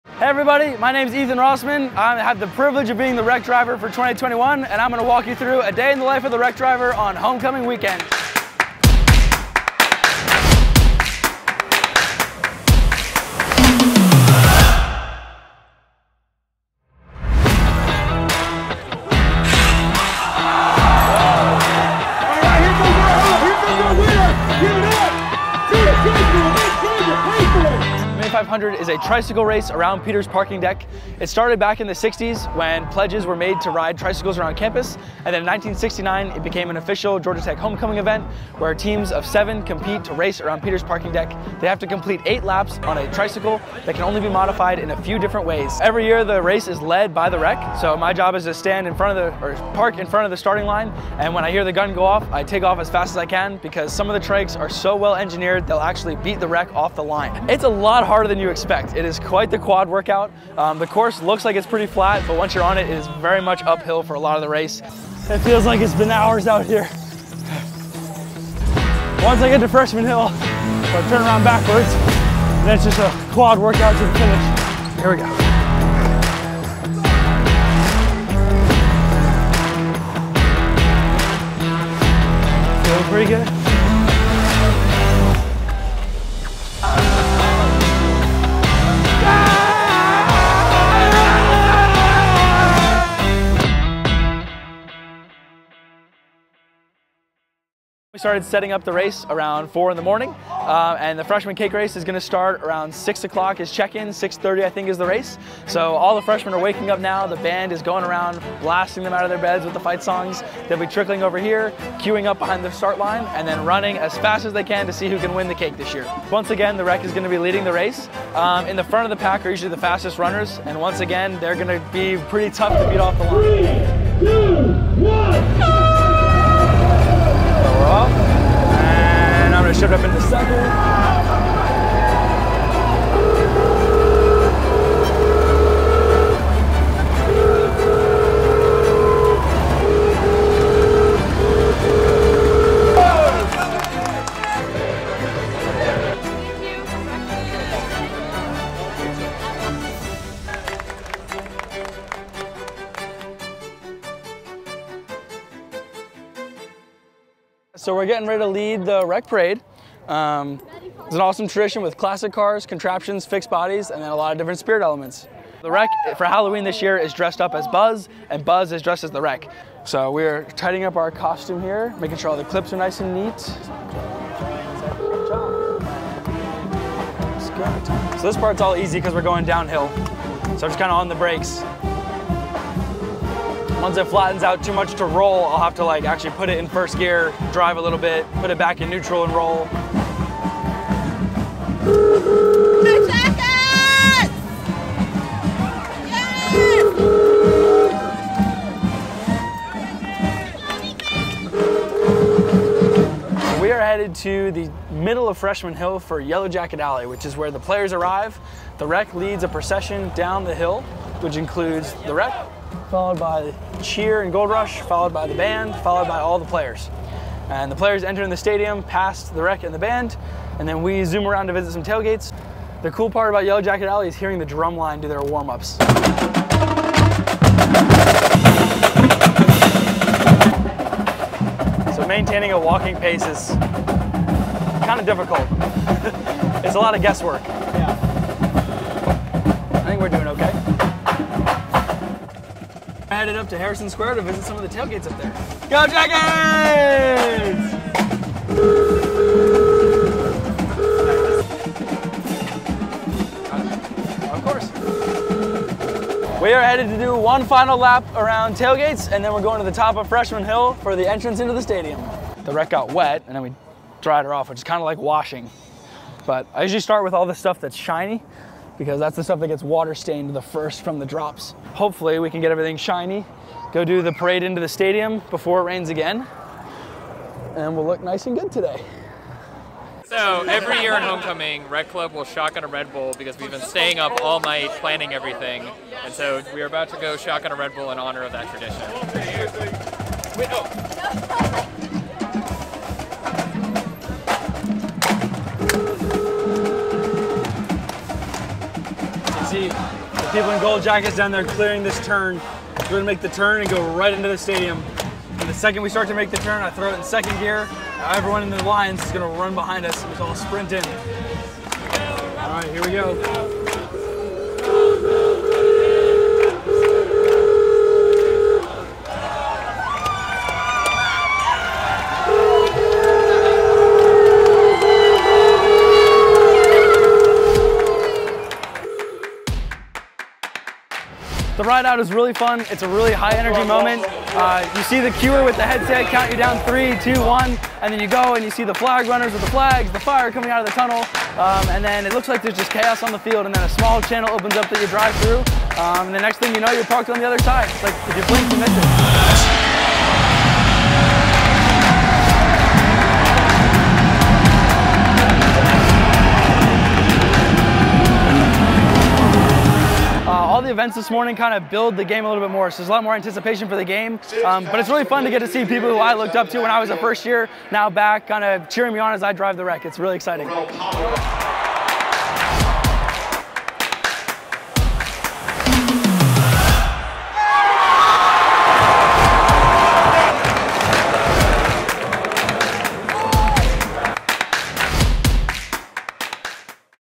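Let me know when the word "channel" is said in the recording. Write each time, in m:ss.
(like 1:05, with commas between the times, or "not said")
5:44.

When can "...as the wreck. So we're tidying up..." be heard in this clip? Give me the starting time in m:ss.
2:49.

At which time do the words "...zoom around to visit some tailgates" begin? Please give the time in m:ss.
3:41.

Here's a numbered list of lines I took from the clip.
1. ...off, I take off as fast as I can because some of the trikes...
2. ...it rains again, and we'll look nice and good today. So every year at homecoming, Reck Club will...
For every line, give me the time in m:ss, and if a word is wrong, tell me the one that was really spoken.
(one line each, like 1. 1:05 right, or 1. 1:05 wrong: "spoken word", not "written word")
1. 0:52 right
2. 4:35 right.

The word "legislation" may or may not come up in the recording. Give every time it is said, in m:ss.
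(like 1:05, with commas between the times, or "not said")
not said.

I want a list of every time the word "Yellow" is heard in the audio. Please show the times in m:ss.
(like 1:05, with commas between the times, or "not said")
3:26, 3:43, 5:00.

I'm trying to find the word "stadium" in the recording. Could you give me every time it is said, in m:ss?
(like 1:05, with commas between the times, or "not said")
3:38, 4:21, 4:34, 5:04.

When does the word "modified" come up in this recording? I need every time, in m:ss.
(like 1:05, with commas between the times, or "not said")
0:44.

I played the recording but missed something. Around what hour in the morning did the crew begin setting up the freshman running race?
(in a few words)
4.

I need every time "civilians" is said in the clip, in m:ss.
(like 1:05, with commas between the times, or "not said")
not said.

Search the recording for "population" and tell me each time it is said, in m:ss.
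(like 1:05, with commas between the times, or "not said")
not said.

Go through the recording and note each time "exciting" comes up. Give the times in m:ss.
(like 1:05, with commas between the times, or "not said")
6:10.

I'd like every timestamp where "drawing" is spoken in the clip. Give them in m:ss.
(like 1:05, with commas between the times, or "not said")
not said.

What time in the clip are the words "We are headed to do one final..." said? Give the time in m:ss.
4:16.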